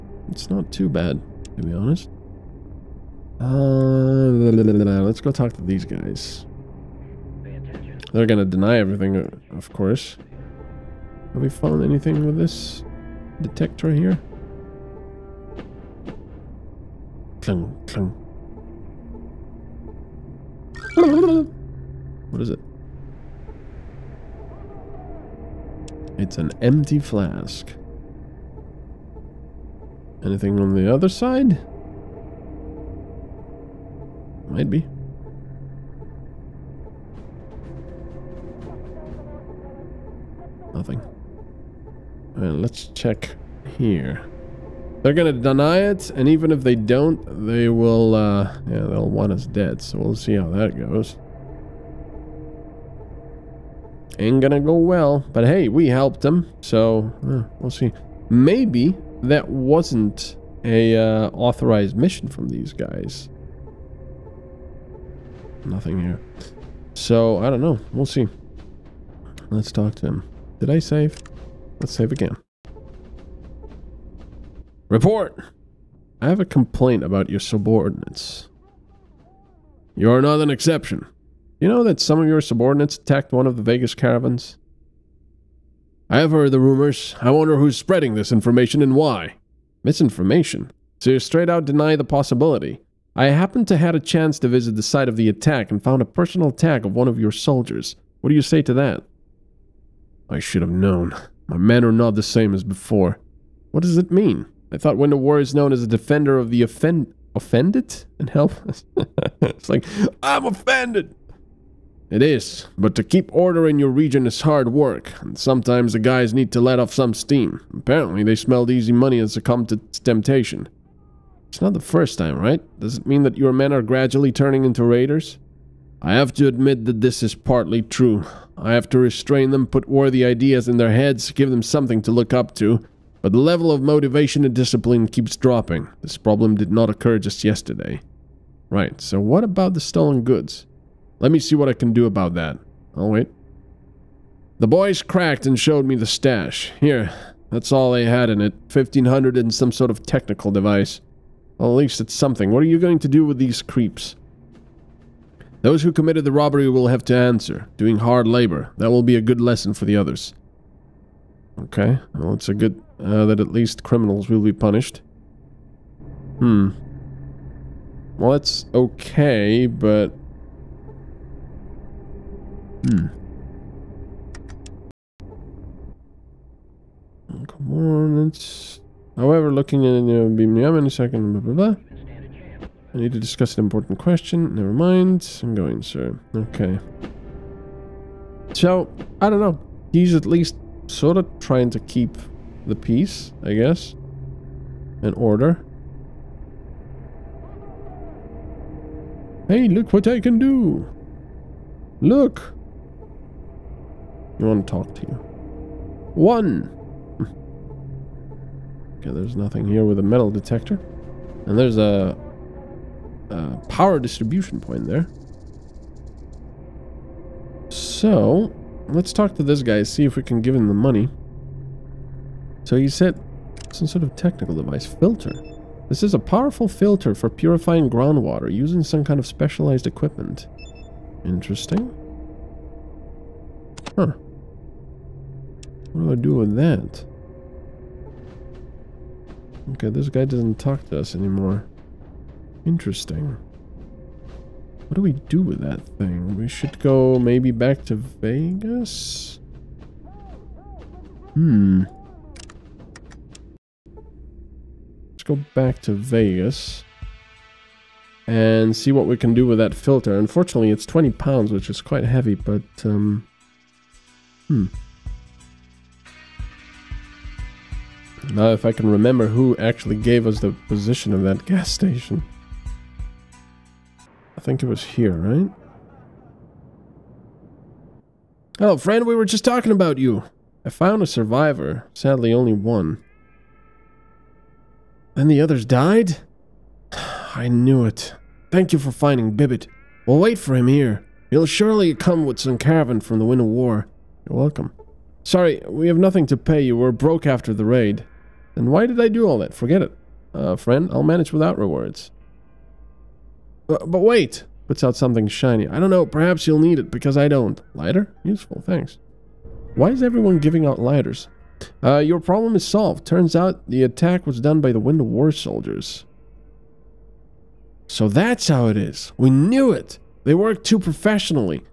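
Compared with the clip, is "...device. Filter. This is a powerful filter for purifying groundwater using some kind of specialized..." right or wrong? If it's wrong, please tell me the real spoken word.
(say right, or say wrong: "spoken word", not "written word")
right.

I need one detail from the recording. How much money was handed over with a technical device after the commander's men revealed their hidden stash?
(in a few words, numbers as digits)
1500.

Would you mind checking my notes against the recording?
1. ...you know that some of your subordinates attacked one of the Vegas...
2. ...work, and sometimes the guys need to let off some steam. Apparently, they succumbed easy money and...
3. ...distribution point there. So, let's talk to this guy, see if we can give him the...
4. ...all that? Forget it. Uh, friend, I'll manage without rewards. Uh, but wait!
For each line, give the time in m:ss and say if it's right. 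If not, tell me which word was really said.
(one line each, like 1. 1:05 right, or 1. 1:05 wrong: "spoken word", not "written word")
1. 1:21 right
2. 1:54 wrong: "smelled", not "succumbed"
3. 3:33 right
4. 4:59 right.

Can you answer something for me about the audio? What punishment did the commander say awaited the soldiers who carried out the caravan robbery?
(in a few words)
Hard labor.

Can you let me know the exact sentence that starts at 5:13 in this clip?
Turns out the attack was done by the Wind War soldiers.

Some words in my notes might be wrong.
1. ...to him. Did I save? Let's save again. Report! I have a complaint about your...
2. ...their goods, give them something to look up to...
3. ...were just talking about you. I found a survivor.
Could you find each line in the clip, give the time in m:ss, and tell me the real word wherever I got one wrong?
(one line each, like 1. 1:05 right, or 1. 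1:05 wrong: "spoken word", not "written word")
1. 1:09 right
2. 2:10 wrong: "heads", not "goods"
3. 4:39 right.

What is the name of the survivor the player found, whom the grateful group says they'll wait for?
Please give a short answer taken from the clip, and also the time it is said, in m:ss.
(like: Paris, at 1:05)
Bibbit, at 4:49.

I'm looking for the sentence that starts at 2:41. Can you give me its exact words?
Okay, well, it's a good uh, that at least criminals will be punished.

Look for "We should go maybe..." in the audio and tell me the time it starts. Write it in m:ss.
4:06.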